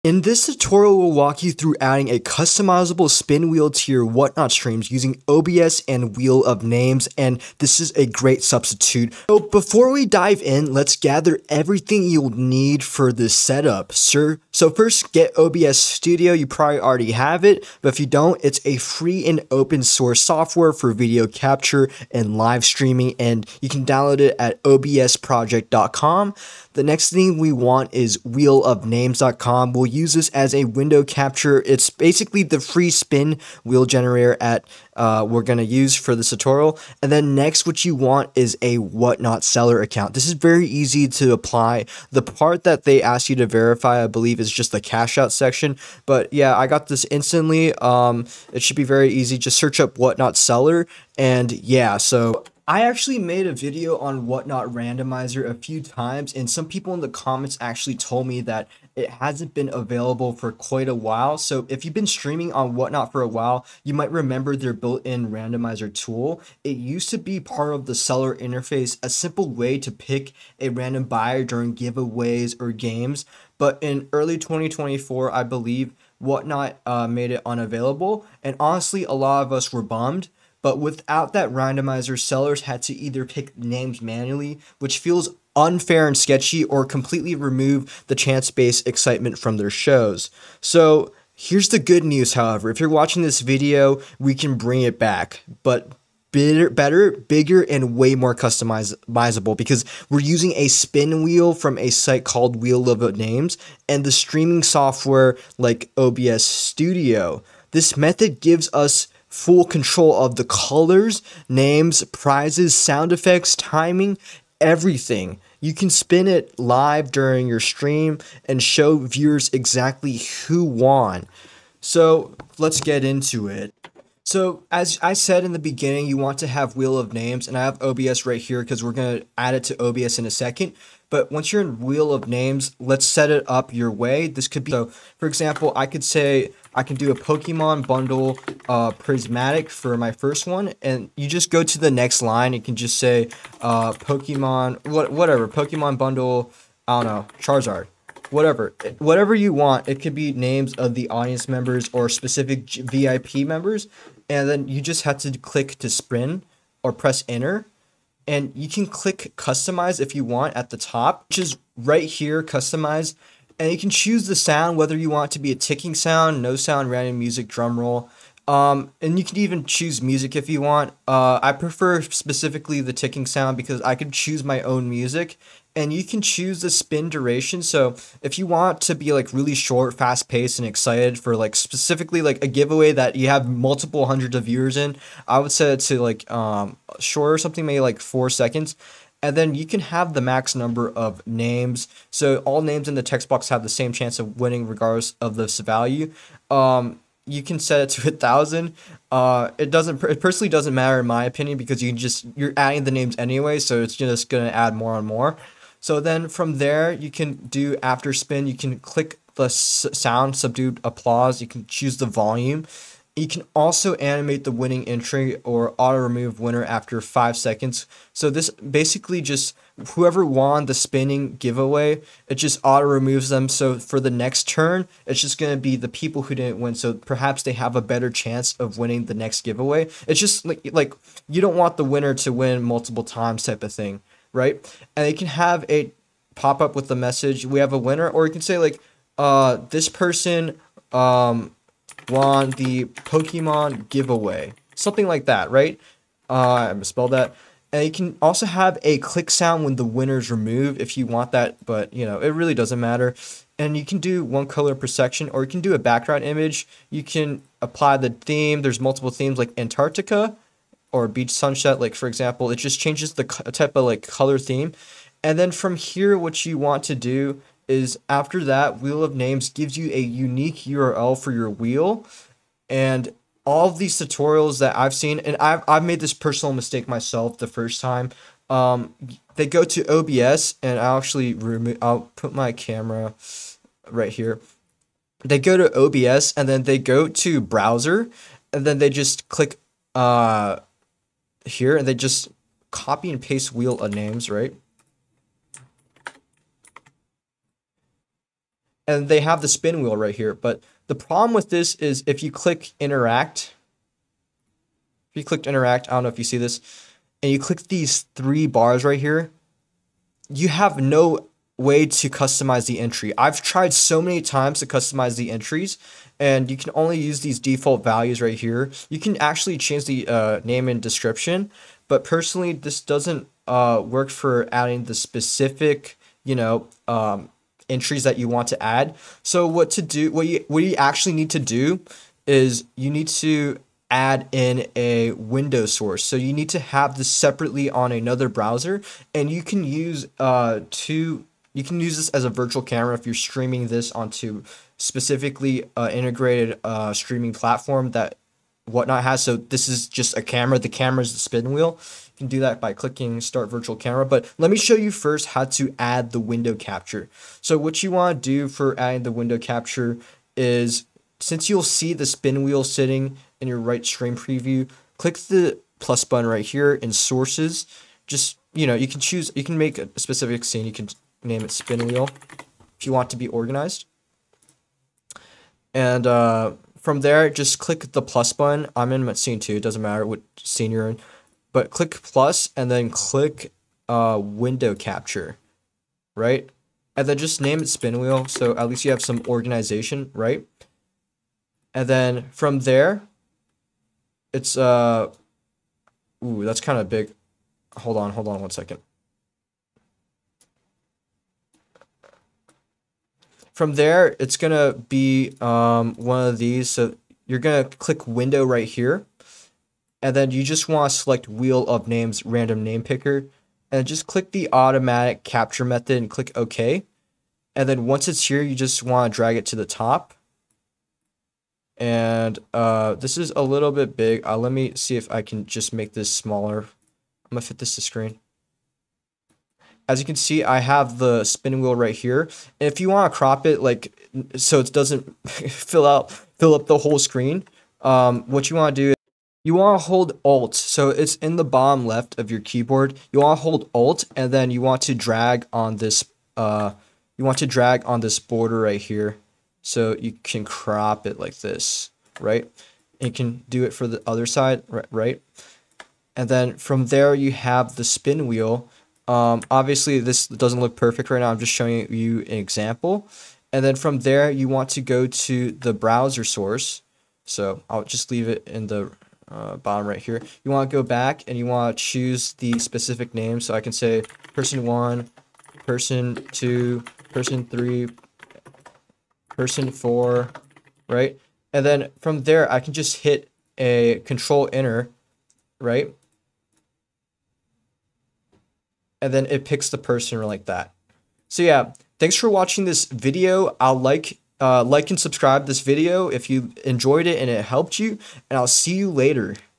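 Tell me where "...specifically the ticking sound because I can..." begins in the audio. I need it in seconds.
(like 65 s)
172 s.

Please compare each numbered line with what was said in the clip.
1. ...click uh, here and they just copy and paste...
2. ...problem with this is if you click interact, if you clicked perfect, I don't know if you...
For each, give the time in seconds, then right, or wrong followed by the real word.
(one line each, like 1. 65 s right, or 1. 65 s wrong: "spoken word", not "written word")
1. 289 s right
2. 300 s wrong: "interact", not "perfect".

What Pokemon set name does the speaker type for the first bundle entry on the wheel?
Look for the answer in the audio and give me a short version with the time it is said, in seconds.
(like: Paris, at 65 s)
prismatic, at 138 s.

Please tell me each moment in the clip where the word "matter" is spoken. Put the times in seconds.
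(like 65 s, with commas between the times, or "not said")
200 s, 252 s, 379 s.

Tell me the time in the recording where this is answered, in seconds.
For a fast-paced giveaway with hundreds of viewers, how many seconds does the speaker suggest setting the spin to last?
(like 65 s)
187 s.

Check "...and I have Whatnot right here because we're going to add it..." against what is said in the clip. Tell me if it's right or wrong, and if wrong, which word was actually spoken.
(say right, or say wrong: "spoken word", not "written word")
wrong: "OBS", not "Whatnot".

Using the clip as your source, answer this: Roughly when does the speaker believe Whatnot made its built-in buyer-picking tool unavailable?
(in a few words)
early 2024.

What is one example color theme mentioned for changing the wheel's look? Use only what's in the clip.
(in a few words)
Antarctica.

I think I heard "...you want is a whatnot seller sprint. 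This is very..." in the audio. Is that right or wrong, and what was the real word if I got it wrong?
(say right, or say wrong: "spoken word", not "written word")
wrong: "account", not "sprint".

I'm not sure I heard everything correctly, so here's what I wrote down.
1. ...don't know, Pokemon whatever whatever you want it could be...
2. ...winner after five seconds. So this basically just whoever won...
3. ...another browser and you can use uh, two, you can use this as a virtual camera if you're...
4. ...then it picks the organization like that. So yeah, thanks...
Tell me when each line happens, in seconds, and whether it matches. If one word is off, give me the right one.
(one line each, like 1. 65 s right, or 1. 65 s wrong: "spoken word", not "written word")
1. 147 s wrong: "Charizard", not "Pokemon"
2. 216 s right
3. 337 s right
4. 489 s wrong: "person", not "organization".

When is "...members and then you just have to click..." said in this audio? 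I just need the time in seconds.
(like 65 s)
153 s.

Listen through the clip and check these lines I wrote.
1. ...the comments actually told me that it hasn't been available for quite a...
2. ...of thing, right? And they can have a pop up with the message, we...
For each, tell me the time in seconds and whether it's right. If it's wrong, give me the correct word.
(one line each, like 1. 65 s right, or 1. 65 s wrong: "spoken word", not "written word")
1. 56 s right
2. 233 s right.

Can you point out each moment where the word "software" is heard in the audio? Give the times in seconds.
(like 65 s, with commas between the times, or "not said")
20 s, 104 s.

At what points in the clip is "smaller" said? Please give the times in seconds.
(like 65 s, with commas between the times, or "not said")
426 s.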